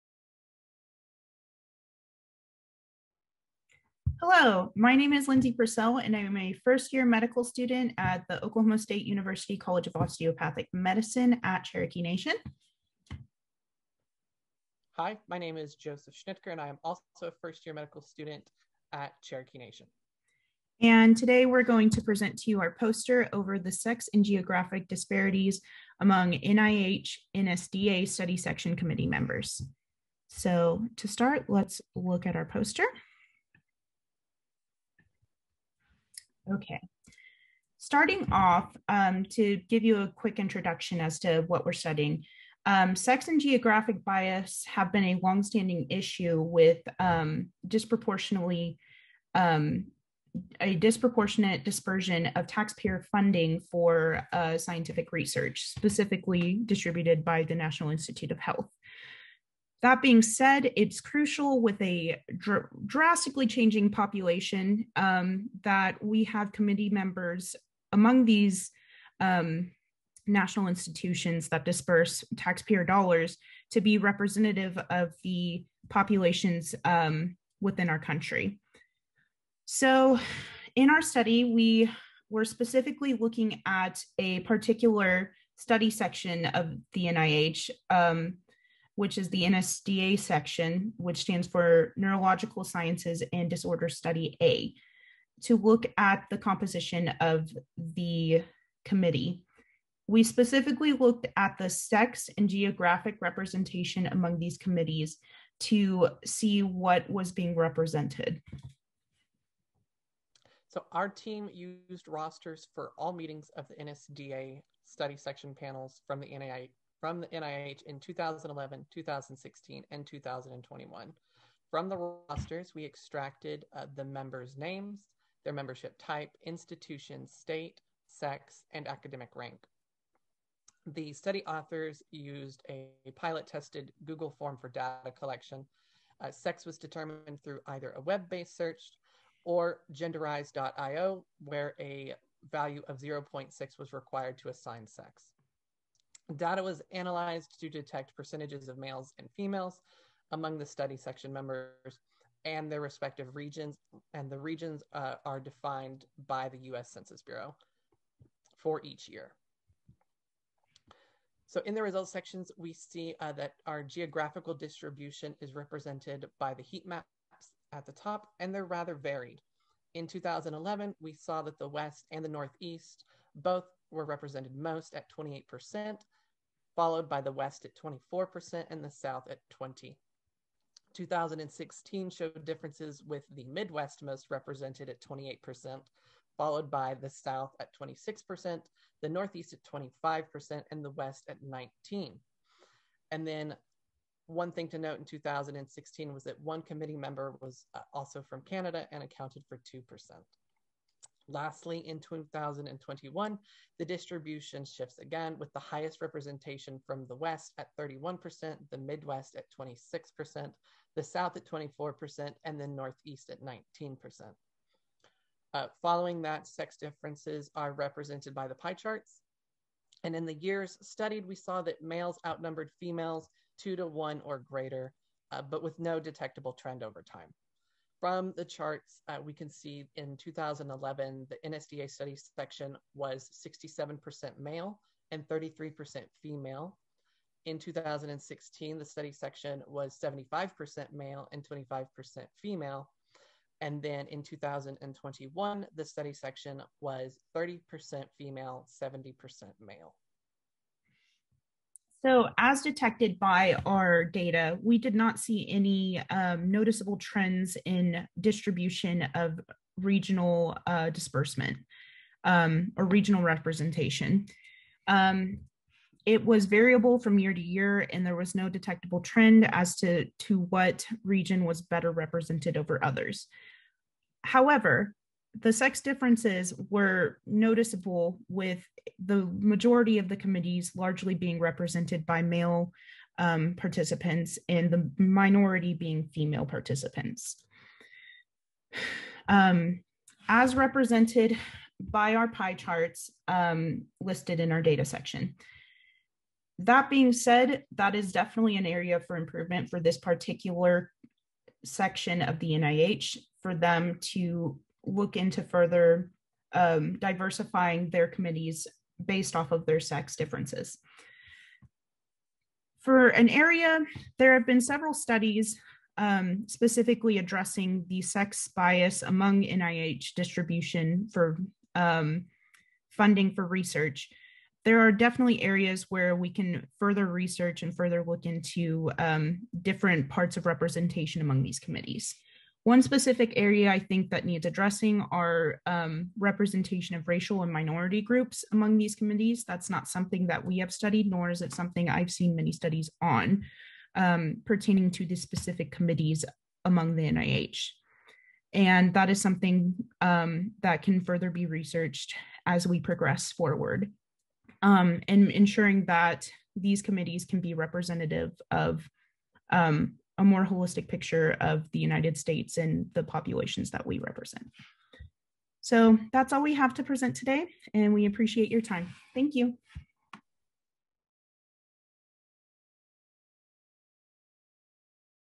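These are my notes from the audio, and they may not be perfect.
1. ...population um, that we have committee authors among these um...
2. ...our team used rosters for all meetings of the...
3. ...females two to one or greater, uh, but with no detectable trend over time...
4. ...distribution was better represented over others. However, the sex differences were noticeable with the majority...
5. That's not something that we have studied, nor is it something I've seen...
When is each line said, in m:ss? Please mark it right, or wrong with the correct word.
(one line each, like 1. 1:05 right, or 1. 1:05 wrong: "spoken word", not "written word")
1. 1:03 wrong: "members", not "authors"
2. 1:50 right
3. 3:42 right
4. 4:31 wrong: "region", not "distribution"
5. 5:39 right.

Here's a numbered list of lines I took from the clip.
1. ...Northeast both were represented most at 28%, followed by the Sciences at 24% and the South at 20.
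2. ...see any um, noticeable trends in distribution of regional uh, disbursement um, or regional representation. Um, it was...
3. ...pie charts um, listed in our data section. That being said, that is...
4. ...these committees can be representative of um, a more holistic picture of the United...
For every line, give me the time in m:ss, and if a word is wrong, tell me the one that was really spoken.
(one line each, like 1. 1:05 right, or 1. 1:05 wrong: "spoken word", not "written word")
1. 2:52 wrong: "West", not "Sciences"
2. 4:15 right
3. 4:52 right
4. 5:56 right.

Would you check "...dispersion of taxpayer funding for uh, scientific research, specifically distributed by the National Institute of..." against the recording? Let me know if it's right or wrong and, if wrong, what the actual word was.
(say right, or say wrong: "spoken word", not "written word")
right.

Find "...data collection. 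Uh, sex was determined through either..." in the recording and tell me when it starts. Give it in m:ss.
2:14.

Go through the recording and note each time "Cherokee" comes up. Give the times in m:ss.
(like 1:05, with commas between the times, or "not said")
0:11, 0:19.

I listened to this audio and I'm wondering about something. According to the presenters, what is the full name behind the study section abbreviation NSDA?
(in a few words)
Neurological Sciences and Disorder Study A.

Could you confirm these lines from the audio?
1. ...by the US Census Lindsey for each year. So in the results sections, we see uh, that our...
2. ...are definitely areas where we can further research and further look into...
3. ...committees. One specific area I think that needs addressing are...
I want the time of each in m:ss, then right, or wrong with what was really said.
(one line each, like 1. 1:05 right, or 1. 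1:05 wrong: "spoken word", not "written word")
1. 2:36 wrong: "Bureau", not "Lindsey"
2. 5:24 right
3. 5:31 right.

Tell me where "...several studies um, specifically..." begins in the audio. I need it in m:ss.
5:14.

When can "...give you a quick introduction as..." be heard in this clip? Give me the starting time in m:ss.
0:39.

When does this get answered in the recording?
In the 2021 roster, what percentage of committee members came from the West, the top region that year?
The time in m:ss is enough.
3:27.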